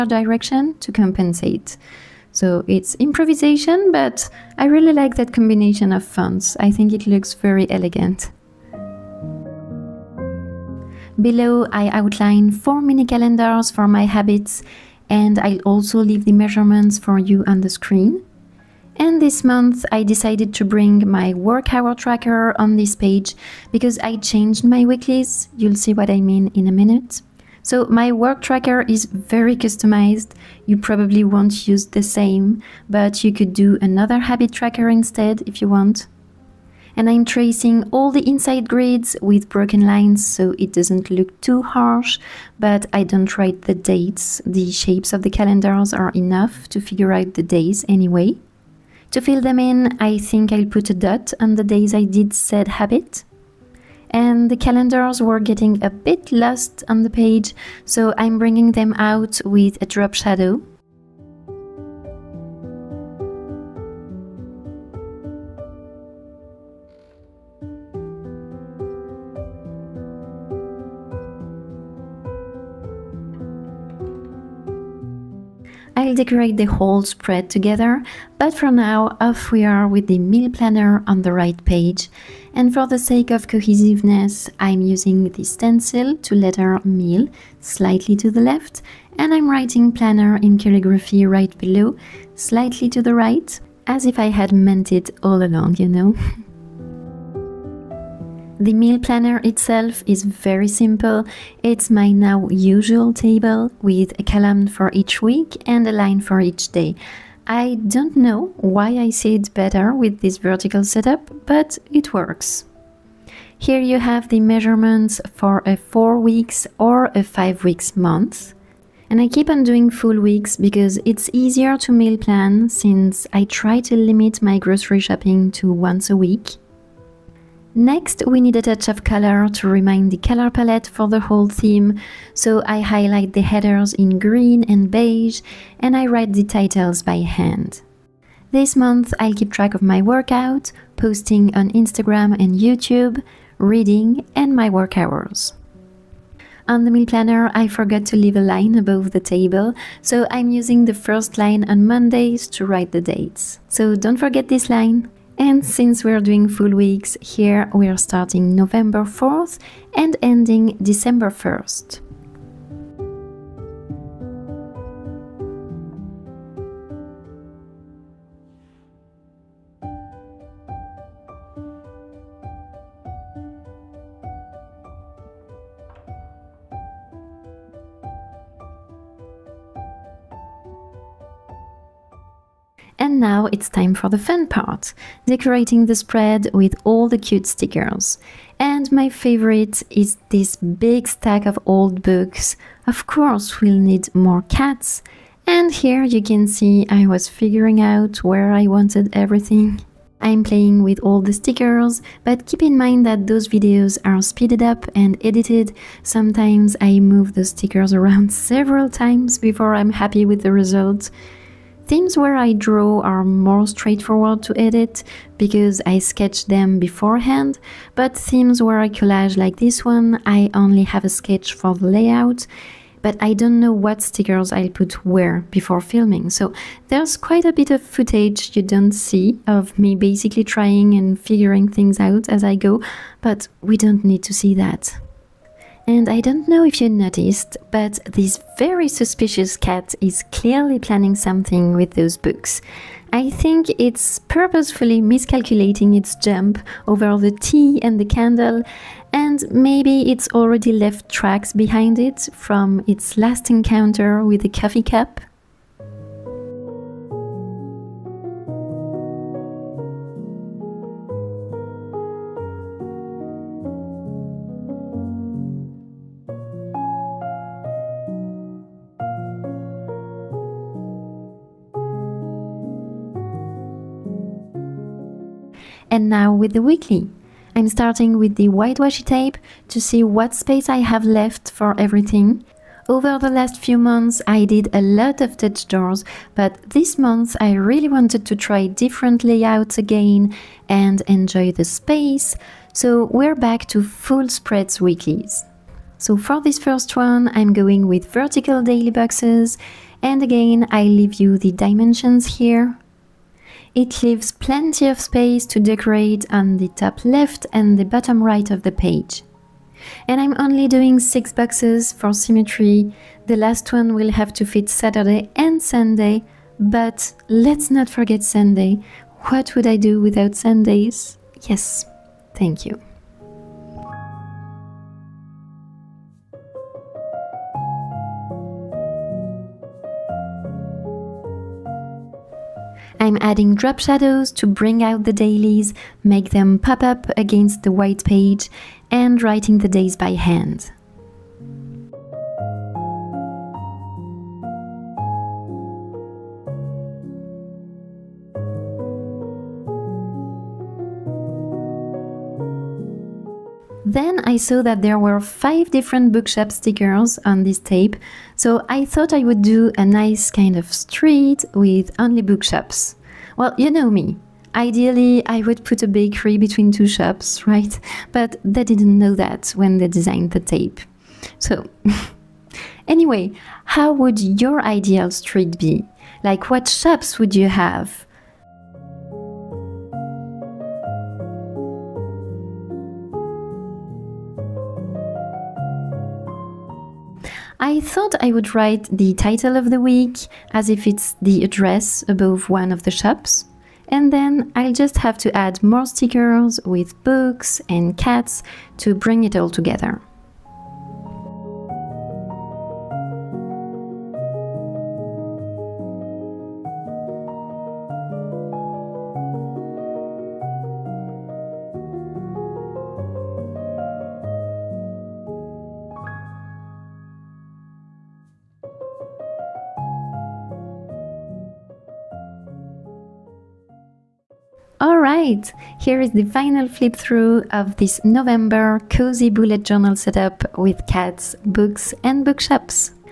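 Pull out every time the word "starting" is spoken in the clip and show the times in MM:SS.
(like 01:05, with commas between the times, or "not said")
02:37, 04:37.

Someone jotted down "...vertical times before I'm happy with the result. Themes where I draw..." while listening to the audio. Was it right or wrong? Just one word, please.
wrong.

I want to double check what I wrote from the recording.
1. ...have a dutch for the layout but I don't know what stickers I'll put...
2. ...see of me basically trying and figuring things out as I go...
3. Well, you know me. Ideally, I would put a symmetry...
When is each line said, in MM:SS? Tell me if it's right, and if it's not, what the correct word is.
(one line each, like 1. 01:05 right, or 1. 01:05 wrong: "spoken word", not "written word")
1. 03:40 wrong: "sketch", not "dutch"
2. 03:48 right
3. 06:03 wrong: "bakery", not "symmetry".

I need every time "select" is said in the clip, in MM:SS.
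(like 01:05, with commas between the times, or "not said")
not said.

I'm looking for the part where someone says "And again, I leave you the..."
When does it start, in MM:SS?
05:00.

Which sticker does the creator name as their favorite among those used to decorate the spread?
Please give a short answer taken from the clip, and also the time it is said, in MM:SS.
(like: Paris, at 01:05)
Stack of old books, at 03:10.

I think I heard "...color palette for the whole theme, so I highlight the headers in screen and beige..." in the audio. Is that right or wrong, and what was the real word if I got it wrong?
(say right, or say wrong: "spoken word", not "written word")
wrong: "green", not "screen".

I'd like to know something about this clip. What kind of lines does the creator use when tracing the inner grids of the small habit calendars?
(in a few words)
Broken lines.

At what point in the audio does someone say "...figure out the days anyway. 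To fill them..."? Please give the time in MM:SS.
00:46.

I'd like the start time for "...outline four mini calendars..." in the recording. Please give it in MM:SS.
00:11.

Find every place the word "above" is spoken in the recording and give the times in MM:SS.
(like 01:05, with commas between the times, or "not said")
02:28, 06:32.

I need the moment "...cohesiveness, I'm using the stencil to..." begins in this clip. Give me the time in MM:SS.
01:23.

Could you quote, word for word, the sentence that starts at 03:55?
And I don't know if you noticed, but this very suspicious cat is clearly planning something with those books.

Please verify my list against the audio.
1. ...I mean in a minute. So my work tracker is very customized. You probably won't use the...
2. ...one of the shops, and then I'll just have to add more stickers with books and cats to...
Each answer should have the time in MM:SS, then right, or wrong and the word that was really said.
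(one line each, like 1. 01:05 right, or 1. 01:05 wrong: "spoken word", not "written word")
1. 00:26 right
2. 06:32 right.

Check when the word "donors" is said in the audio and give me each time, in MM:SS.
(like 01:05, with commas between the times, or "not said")
not said.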